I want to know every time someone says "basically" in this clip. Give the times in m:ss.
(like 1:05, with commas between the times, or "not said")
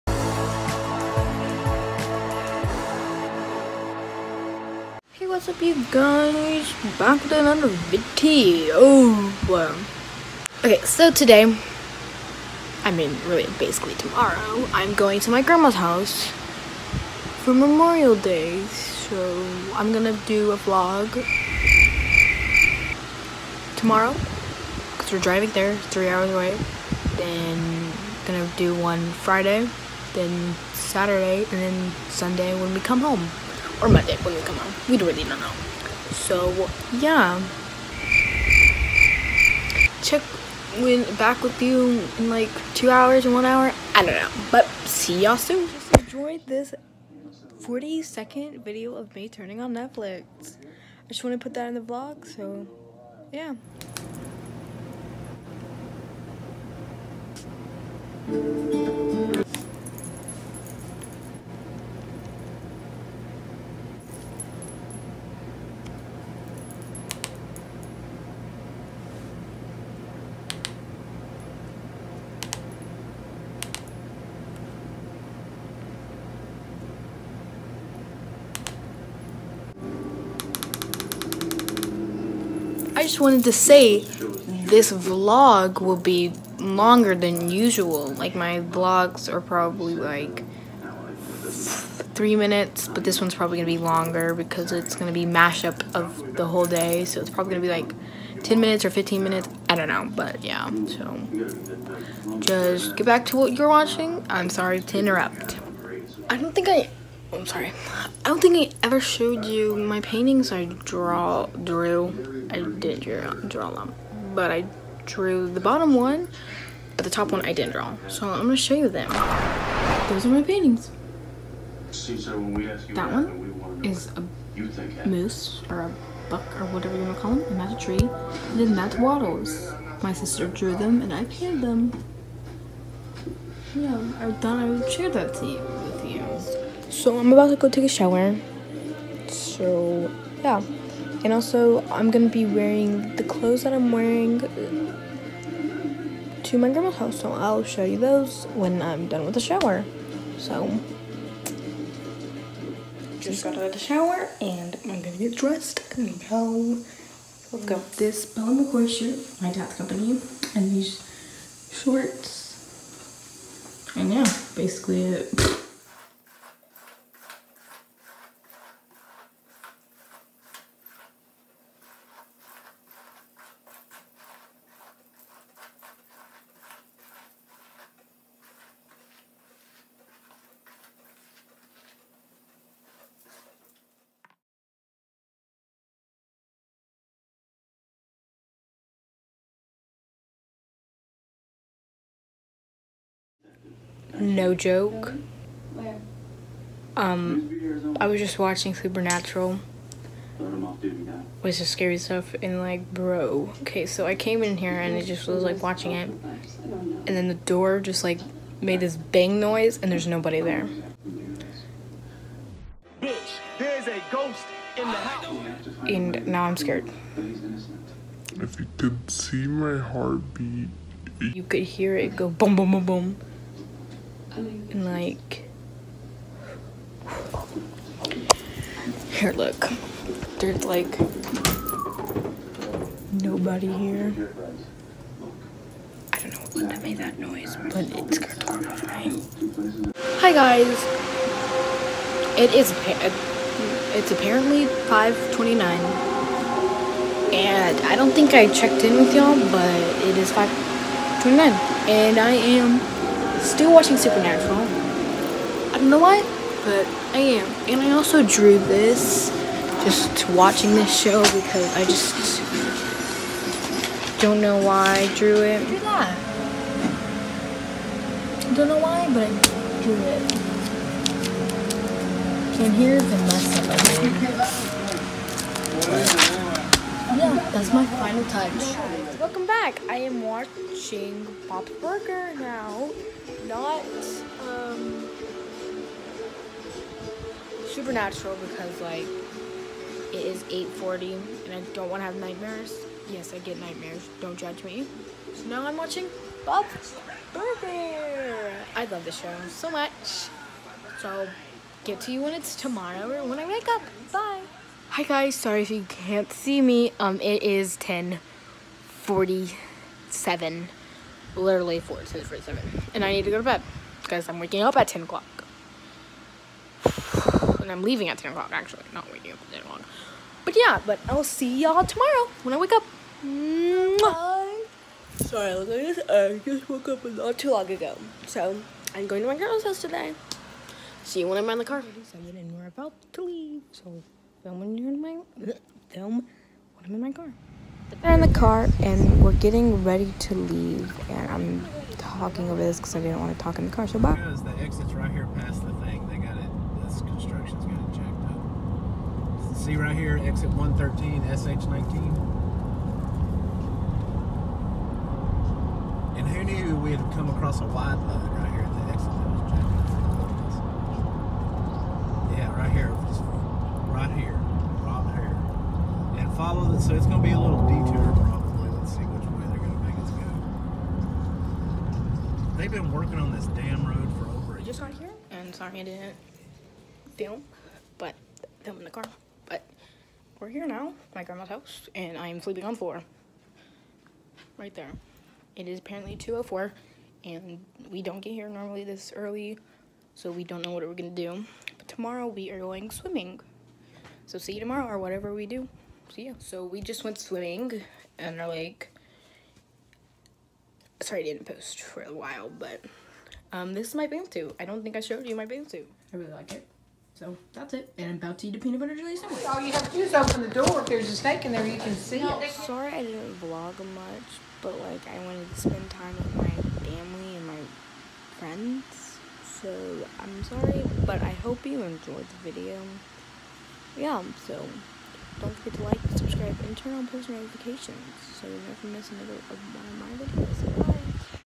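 0:13, 2:44.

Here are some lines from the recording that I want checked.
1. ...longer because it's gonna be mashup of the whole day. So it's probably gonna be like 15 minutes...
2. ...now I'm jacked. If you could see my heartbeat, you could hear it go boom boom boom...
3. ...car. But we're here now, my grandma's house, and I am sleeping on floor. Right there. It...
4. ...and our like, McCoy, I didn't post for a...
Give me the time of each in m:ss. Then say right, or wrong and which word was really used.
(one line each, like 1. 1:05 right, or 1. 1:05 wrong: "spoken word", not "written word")
1. 1:33 wrong: "10", not "15"
2. 3:36 wrong: "scared", not "jacked"
3. 6:18 right
4. 6:38 wrong: "Sorry", not "McCoy".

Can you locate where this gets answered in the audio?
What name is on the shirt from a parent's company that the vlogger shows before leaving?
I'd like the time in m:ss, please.
2:38.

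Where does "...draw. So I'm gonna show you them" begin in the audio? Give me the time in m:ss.
1:57.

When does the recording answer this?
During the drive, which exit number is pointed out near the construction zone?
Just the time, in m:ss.
5:50.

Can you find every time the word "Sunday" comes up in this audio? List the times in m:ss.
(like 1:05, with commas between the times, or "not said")
0:32.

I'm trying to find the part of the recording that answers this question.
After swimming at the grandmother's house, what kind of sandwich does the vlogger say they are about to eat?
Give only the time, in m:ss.
6:48.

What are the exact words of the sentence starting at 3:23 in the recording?
Okay, so I came in here and it just was like watching it.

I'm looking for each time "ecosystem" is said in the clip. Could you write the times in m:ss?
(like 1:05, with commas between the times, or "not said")
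not said.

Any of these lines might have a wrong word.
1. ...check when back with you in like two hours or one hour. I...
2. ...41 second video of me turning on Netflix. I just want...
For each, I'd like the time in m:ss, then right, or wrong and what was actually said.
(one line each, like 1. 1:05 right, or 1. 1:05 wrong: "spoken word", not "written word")
1. 0:40 right
2. 0:47 wrong: "40", not "41".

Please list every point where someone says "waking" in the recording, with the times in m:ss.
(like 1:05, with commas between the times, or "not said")
5:14, 5:19.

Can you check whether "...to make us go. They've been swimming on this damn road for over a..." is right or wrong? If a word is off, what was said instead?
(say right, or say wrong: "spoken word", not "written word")
wrong: "working", not "swimming".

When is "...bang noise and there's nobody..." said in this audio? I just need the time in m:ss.
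3:28.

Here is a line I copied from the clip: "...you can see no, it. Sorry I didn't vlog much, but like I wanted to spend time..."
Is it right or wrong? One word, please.
right.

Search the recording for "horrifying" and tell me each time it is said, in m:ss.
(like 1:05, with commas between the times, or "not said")
3:58.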